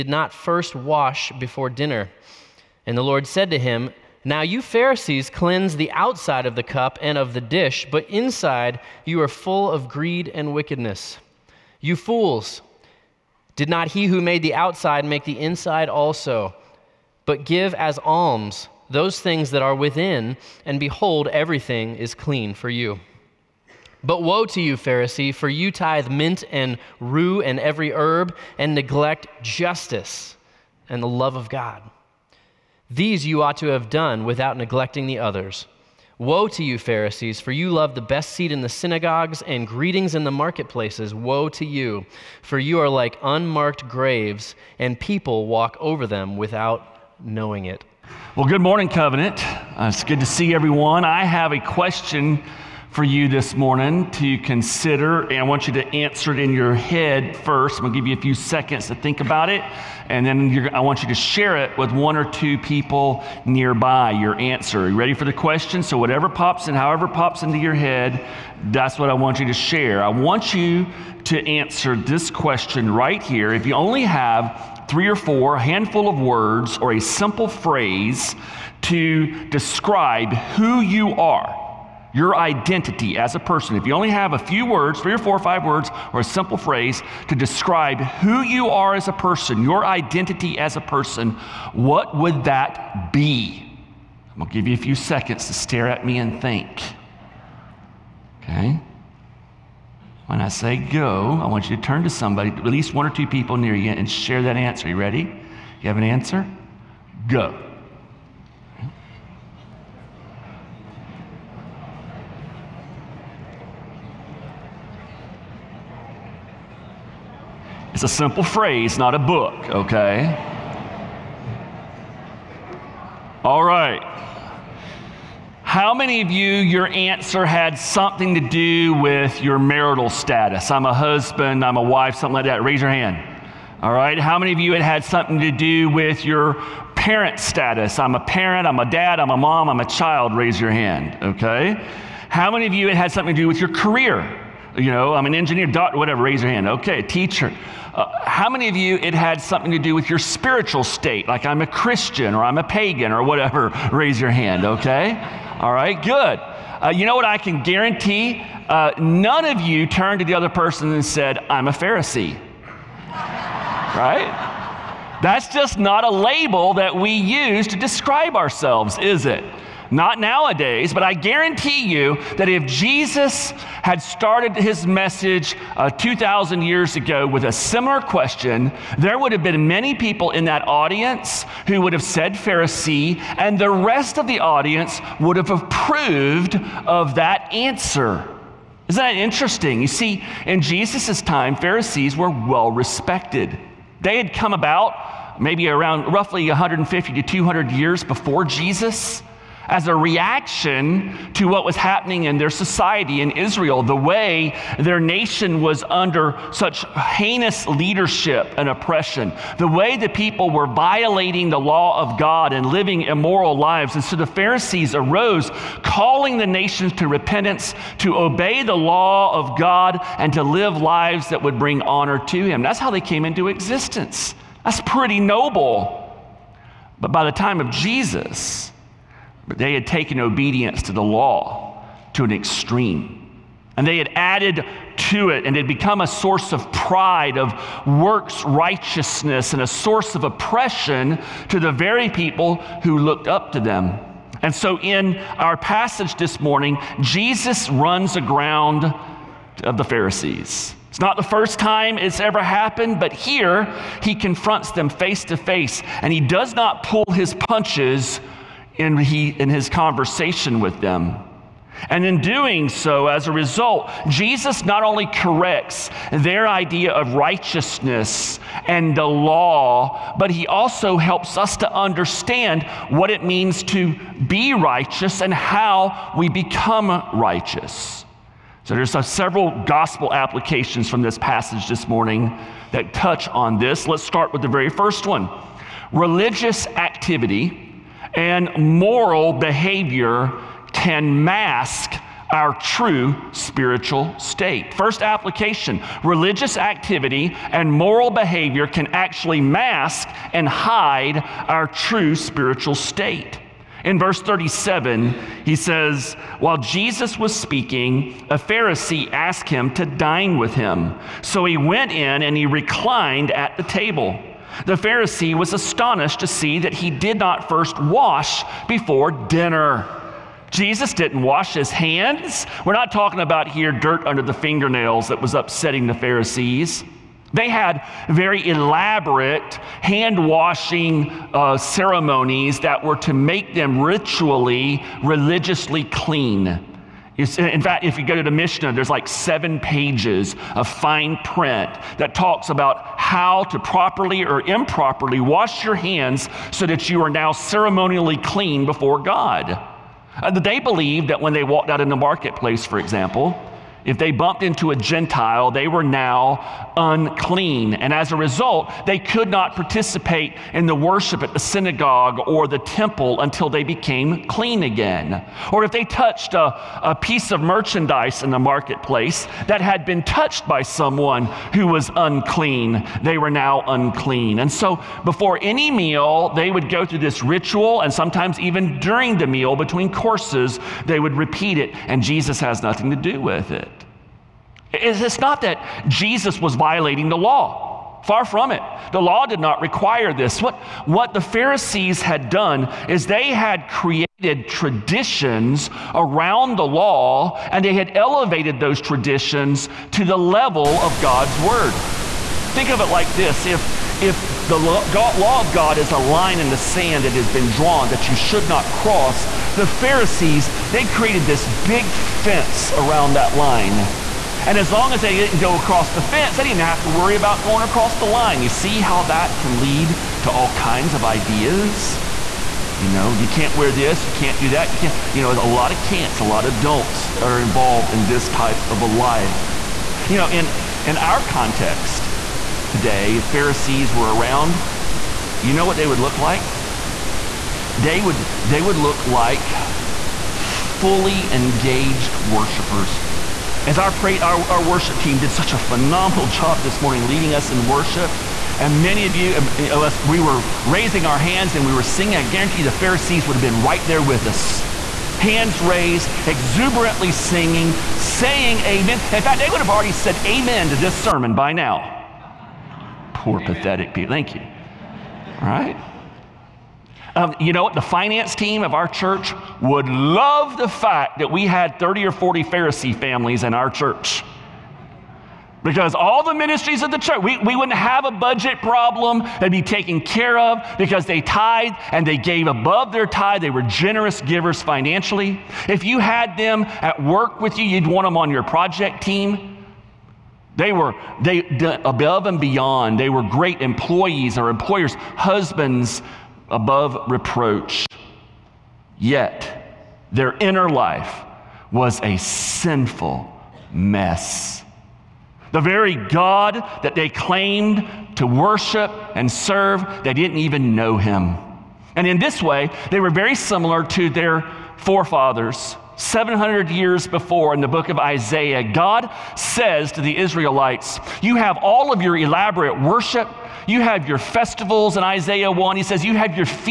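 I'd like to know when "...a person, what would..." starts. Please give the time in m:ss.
1:30.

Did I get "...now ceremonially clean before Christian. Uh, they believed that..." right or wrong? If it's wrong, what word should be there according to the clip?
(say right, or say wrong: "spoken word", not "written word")
wrong: "God", not "Christian".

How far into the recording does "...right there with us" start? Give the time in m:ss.
7:33.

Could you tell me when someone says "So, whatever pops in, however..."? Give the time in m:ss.
1:05.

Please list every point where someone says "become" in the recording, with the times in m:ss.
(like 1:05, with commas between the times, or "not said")
3:55, 4:36.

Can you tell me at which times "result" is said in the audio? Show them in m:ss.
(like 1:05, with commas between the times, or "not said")
4:23, 5:58.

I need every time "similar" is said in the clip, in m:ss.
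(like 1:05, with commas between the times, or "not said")
2:57, 8:33.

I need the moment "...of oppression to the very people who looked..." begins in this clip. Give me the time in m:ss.
4:00.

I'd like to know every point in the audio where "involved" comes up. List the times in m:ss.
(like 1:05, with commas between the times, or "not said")
7:07.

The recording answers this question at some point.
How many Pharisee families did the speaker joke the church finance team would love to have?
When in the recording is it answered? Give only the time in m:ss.
7:51.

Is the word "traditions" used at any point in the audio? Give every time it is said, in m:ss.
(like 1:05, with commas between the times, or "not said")
6:34, 6:38.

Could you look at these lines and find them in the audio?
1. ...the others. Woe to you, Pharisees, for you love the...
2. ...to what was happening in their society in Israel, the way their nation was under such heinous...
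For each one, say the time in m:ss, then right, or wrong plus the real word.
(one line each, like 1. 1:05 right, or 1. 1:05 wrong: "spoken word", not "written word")
1. 0:35 right
2. 3:21 right.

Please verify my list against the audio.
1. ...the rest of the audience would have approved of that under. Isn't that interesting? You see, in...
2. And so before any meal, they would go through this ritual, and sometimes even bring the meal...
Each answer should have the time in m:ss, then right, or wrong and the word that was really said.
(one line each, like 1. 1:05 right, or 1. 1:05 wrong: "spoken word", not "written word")
1. 3:03 wrong: "answer", not "under"
2. 6:14 wrong: "during", not "bring".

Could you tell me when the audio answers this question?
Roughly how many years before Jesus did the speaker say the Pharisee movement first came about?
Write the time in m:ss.
3:16.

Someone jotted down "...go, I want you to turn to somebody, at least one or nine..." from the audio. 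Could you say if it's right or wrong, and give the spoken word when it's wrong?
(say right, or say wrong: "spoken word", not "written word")
wrong: "two", not "nine".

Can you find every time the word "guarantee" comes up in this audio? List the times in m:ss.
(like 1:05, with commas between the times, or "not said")
2:37, 2:51, 7:32.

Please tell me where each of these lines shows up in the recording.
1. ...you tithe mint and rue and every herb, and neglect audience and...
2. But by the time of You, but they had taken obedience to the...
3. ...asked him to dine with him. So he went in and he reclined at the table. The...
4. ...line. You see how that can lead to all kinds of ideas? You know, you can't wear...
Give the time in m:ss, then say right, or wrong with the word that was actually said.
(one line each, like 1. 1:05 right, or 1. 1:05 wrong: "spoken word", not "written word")
1. 0:25 wrong: "justice", not "audience"
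2. 3:46 wrong: "Jesus", not "You"
3. 5:09 right
4. 6:58 right.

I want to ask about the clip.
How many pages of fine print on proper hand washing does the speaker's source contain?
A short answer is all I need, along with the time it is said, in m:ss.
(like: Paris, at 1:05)
7, at 5:39.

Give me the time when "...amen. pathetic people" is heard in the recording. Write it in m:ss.
7:43.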